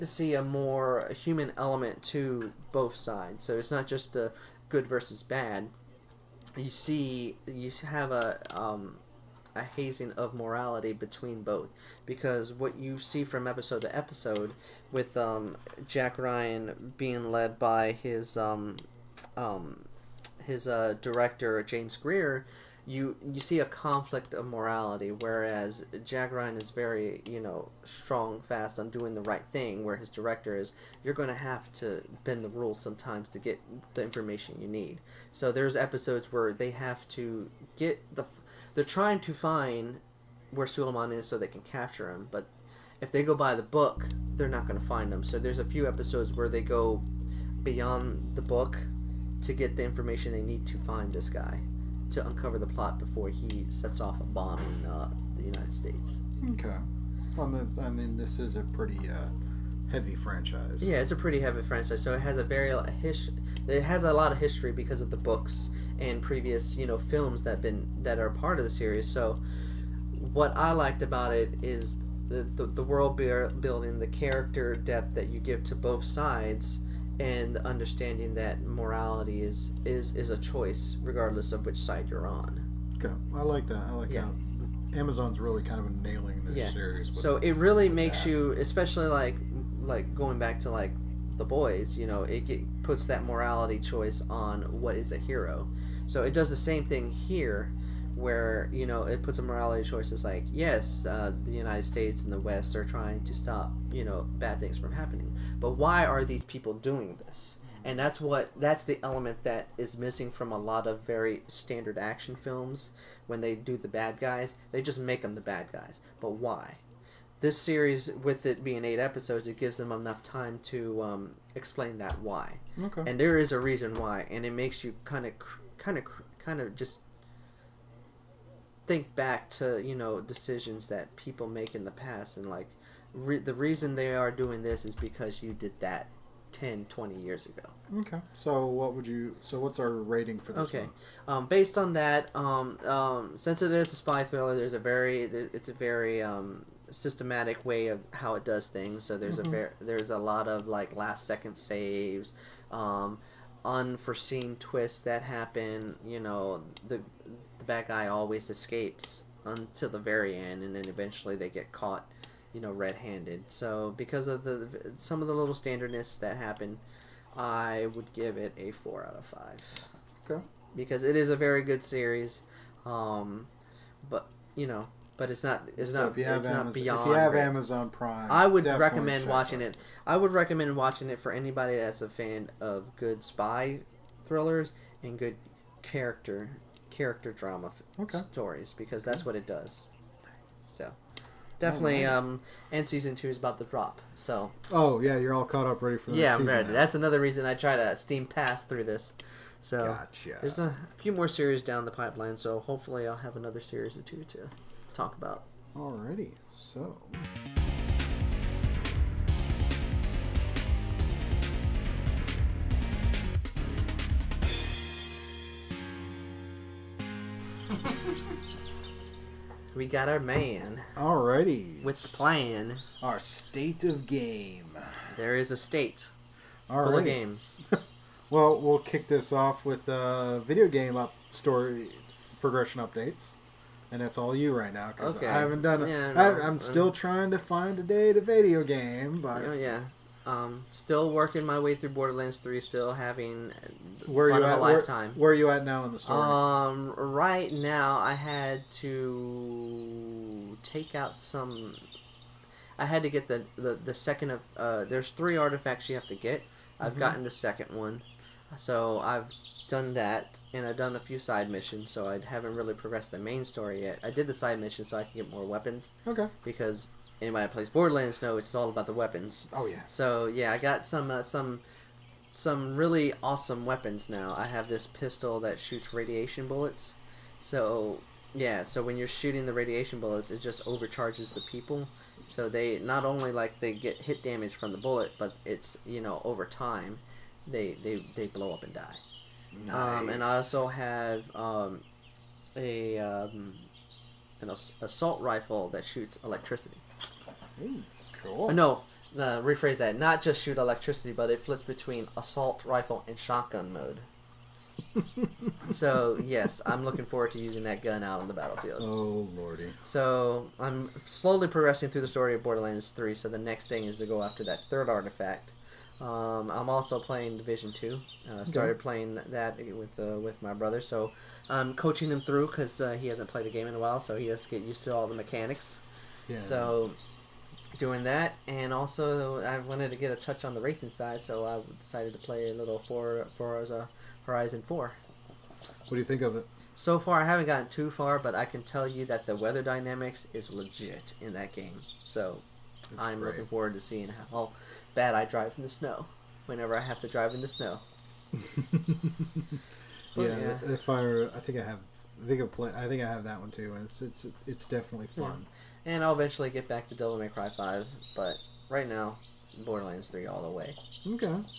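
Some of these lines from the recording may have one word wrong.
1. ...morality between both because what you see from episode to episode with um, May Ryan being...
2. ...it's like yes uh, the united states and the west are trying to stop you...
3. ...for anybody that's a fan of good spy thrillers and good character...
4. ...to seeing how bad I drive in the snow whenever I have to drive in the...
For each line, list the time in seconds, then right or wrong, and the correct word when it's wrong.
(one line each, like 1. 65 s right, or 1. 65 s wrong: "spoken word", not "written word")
1. 10 s wrong: "Jack", not "May"
2. 100 s right
3. 181 s right
4. 343 s right.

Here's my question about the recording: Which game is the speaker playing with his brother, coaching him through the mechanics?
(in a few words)
Division Two.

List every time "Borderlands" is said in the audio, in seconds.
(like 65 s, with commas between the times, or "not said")
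241 s, 267 s, 312 s, 359 s.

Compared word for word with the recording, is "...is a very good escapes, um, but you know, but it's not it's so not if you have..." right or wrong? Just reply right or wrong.
wrong.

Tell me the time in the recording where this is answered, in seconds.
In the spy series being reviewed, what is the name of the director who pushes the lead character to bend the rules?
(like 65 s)
21 s.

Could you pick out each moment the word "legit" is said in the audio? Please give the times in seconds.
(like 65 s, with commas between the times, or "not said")
340 s.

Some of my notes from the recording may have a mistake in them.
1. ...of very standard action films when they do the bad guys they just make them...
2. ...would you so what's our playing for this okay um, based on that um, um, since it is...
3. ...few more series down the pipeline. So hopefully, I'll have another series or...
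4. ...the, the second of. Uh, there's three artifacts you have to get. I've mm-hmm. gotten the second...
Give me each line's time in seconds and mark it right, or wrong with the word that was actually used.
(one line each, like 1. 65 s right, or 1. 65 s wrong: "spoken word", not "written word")
1. 110 s right
2. 138 s wrong: "rating", not "playing"
3. 200 s right
4. 253 s right.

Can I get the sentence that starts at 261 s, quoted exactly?
So I haven't really progressed the main story yet.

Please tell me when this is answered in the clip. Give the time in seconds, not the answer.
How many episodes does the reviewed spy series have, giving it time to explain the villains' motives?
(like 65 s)
118 s.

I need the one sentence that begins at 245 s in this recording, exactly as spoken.
Where, where, are you at now in the story?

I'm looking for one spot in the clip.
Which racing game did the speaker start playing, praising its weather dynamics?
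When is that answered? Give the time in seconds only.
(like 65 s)
333 s.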